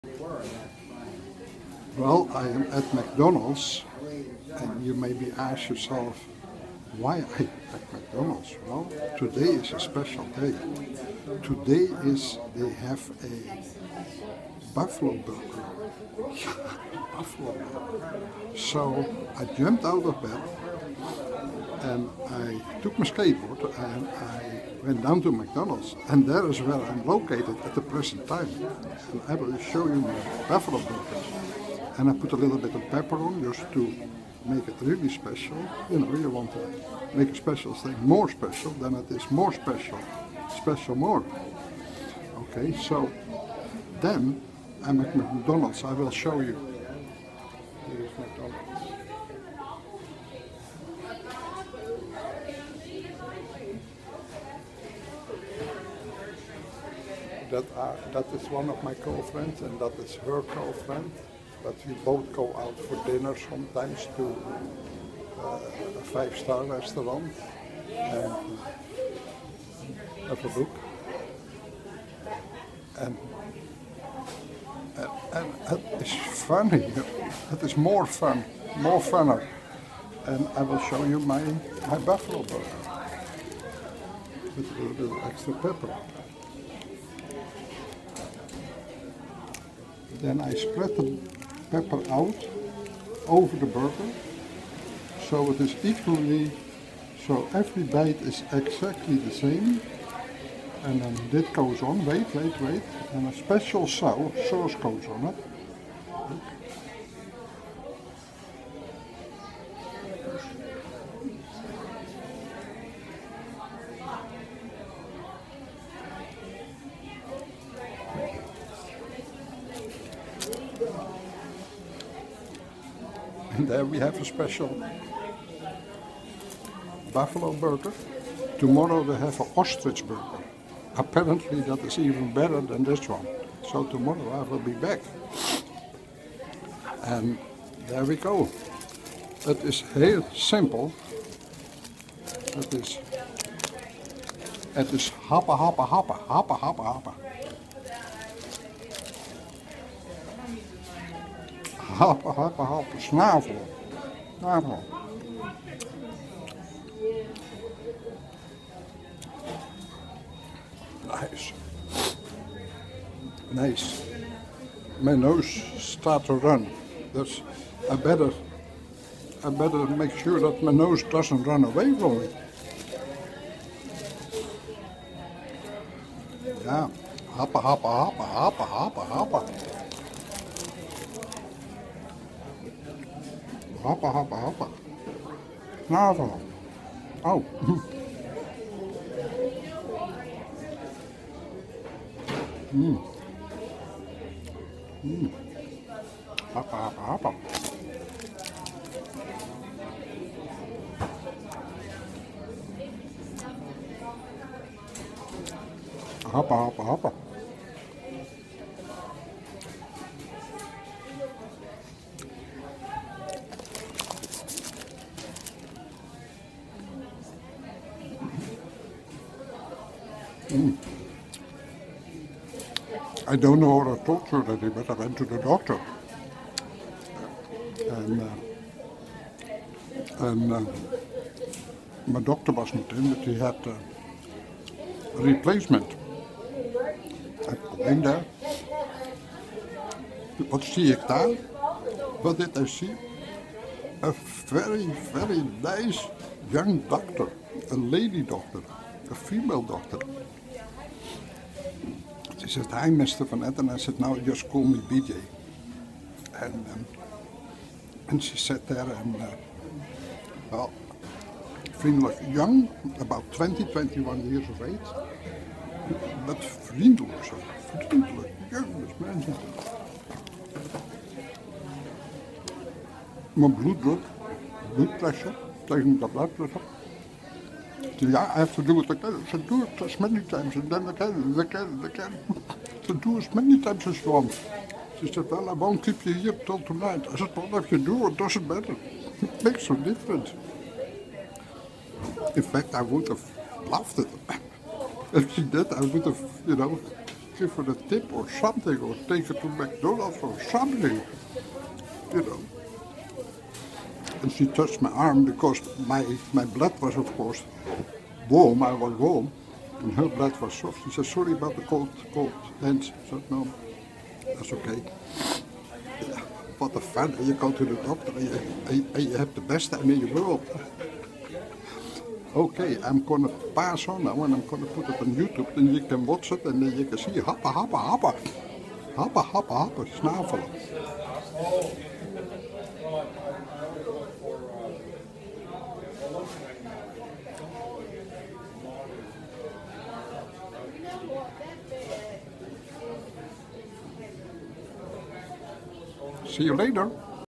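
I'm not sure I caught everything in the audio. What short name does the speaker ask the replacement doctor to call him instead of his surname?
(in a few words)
BJ.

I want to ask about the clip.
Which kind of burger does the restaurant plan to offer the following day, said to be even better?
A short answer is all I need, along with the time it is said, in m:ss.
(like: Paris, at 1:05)
Ostrich burger, at 2:09.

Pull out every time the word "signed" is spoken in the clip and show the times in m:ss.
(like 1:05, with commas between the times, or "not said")
not said.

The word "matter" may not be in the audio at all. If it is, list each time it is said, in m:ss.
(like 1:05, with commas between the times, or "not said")
4:48.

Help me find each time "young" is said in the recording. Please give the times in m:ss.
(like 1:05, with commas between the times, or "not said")
4:06, 4:22.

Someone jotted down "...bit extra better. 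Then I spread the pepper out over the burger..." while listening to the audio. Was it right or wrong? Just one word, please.
wrong.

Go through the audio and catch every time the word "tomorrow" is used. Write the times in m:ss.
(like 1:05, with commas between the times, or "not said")
2:08, 2:13.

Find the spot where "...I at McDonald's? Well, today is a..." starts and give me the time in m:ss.
0:07.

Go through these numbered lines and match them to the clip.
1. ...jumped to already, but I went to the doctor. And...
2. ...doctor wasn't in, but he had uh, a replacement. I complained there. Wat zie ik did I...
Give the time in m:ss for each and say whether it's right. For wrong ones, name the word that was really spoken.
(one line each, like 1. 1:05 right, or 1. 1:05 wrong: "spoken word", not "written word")
1. 3:44 wrong: "talked", not "jumped"
2. 3:52 right.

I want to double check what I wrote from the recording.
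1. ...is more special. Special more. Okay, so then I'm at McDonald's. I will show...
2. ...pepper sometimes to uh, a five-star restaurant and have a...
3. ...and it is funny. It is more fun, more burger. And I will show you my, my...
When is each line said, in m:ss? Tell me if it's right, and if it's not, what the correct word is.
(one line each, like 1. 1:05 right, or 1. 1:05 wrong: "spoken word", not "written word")
1. 0:39 right
2. 1:03 wrong: "dinner", not "pepper"
3. 1:15 wrong: "funner", not "burger".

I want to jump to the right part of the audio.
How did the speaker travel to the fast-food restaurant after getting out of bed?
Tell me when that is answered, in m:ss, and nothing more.
0:23.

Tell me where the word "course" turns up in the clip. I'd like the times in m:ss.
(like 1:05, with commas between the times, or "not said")
5:07.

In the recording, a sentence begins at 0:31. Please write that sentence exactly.
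And I put a little bit of pepper on just to make it really special.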